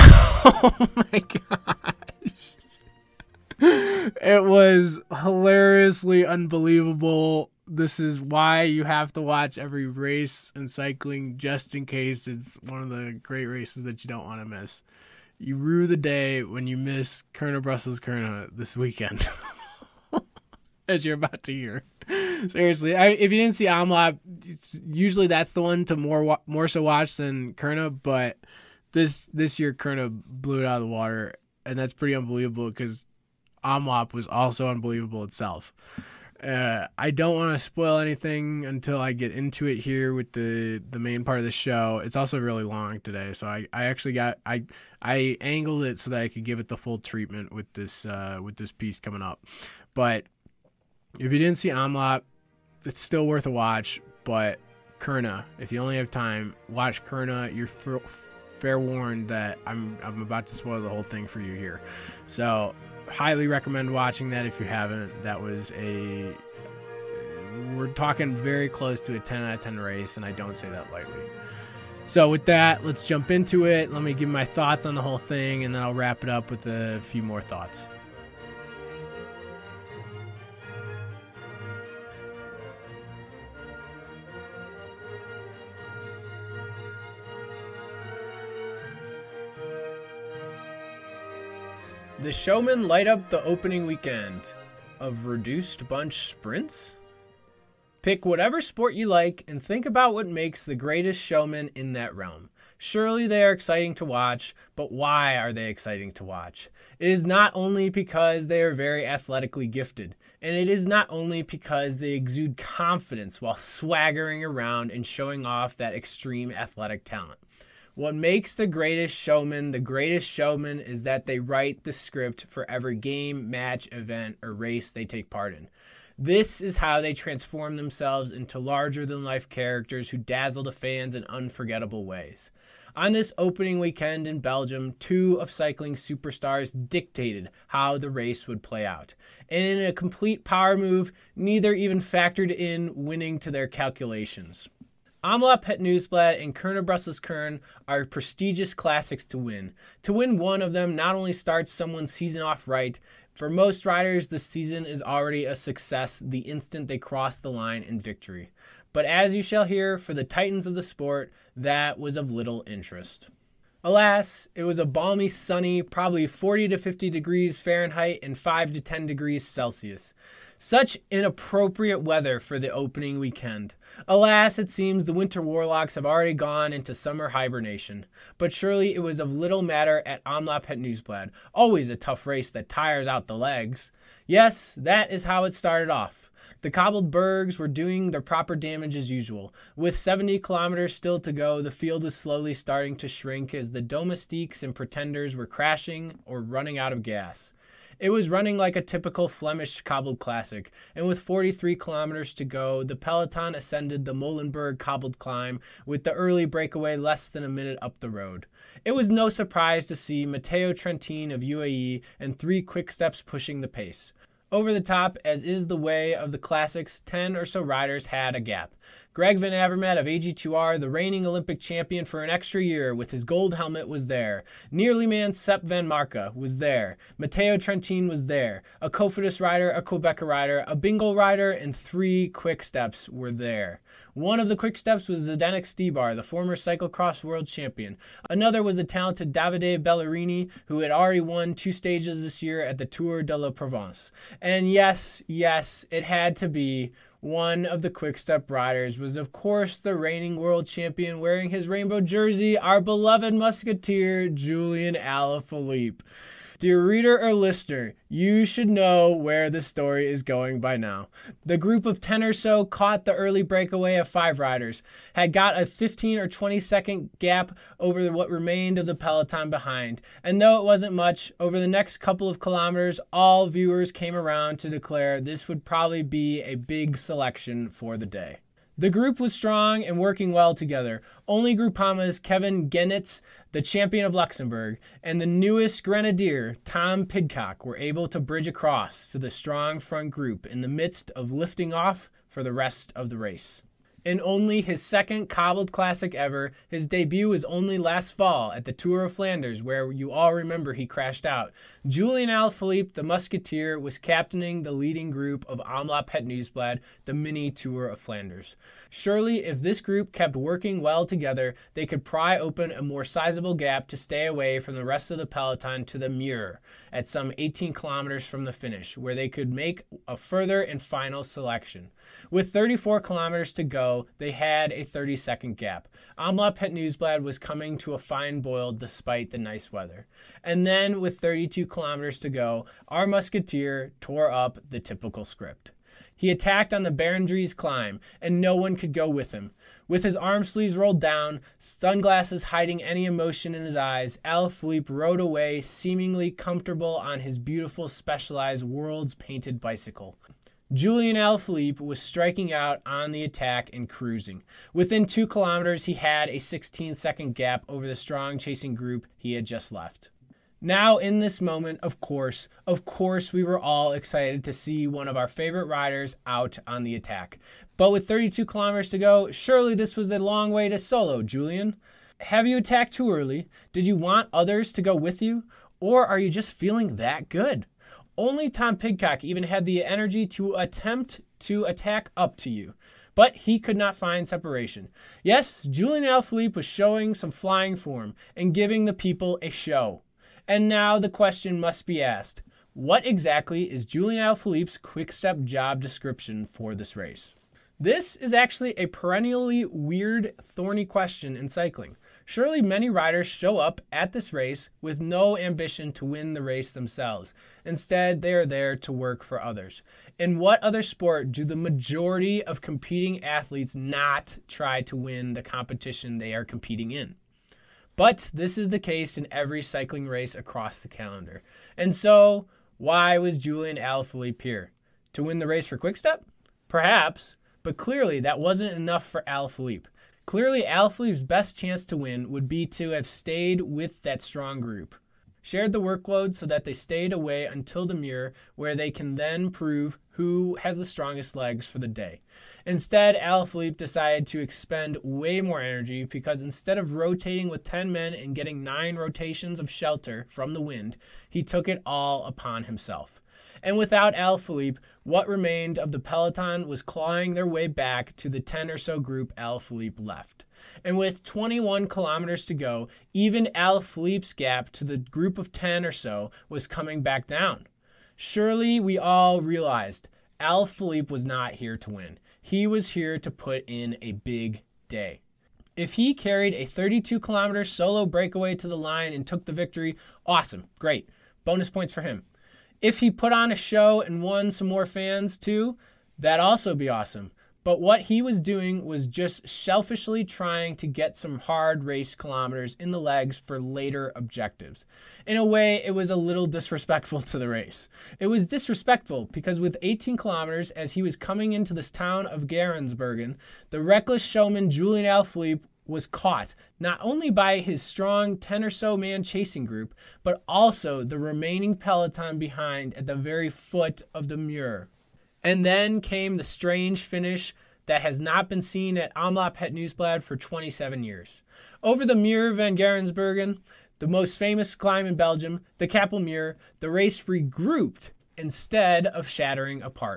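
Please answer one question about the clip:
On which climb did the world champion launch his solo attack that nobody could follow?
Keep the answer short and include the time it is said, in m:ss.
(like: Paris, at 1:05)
Berendries, at 5:36.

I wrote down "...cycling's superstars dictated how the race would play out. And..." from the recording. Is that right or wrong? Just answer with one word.
right.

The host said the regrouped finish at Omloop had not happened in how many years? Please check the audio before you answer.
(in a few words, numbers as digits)
27.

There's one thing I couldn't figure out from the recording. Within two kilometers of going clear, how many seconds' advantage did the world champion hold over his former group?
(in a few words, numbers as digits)
16 seconds.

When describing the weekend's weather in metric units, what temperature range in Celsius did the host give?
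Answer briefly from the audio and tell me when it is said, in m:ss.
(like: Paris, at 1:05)
5 to 10 degrees, at 2:48.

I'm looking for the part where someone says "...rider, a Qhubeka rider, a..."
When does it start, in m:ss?
3:49.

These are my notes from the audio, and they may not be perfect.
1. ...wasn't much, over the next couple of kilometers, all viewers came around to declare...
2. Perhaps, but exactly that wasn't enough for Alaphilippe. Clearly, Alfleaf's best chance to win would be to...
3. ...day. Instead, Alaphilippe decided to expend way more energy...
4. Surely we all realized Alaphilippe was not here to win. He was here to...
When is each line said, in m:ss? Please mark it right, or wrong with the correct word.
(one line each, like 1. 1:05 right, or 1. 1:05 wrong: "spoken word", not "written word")
1. 4:30 right
2. 7:06 wrong: "clearly", not "exactly"
3. 7:21 right
4. 7:48 right.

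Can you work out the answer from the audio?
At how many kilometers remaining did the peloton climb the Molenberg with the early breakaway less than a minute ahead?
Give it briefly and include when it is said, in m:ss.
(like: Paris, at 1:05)
43, at 3:21.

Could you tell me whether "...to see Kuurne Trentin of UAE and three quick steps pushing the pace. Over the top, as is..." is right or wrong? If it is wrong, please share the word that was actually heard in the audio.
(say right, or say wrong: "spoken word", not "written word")
wrong: "Matteo", not "Kuurne".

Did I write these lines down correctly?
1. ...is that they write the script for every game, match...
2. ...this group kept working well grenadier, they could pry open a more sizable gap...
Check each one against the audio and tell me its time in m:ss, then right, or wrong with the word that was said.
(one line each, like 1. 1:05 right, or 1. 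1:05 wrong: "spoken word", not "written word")
1. 2:00 right
2. 5:09 wrong: "together", not "grenadier".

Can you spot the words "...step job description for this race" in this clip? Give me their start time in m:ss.
6:35.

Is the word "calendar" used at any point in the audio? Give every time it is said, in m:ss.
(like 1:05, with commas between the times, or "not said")
7:00.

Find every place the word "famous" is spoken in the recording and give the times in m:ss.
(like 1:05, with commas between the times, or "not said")
8:44.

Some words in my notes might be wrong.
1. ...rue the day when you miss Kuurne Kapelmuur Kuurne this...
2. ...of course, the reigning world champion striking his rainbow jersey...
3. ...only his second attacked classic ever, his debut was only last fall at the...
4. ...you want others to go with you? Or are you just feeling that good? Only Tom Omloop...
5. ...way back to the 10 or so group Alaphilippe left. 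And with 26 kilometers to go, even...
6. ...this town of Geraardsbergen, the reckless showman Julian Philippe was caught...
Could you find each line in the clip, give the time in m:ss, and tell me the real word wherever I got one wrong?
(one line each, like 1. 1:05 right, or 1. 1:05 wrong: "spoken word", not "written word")
1. 0:15 wrong: "Brussels", not "Kapelmuur"
2. 4:09 wrong: "wearing", not "striking"
3. 4:54 wrong: "cobbled", not "attacked"
4. 6:13 wrong: "Pidcock", not "Omloop"
5. 7:37 wrong: "21", not "26"
6. 8:21 wrong: "Alaphilippe", not "Philippe".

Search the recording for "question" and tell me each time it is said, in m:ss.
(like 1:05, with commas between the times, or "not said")
6:31, 6:40.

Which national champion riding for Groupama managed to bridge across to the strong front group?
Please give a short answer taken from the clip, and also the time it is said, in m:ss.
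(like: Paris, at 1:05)
Kevin Geniets, at 4:42.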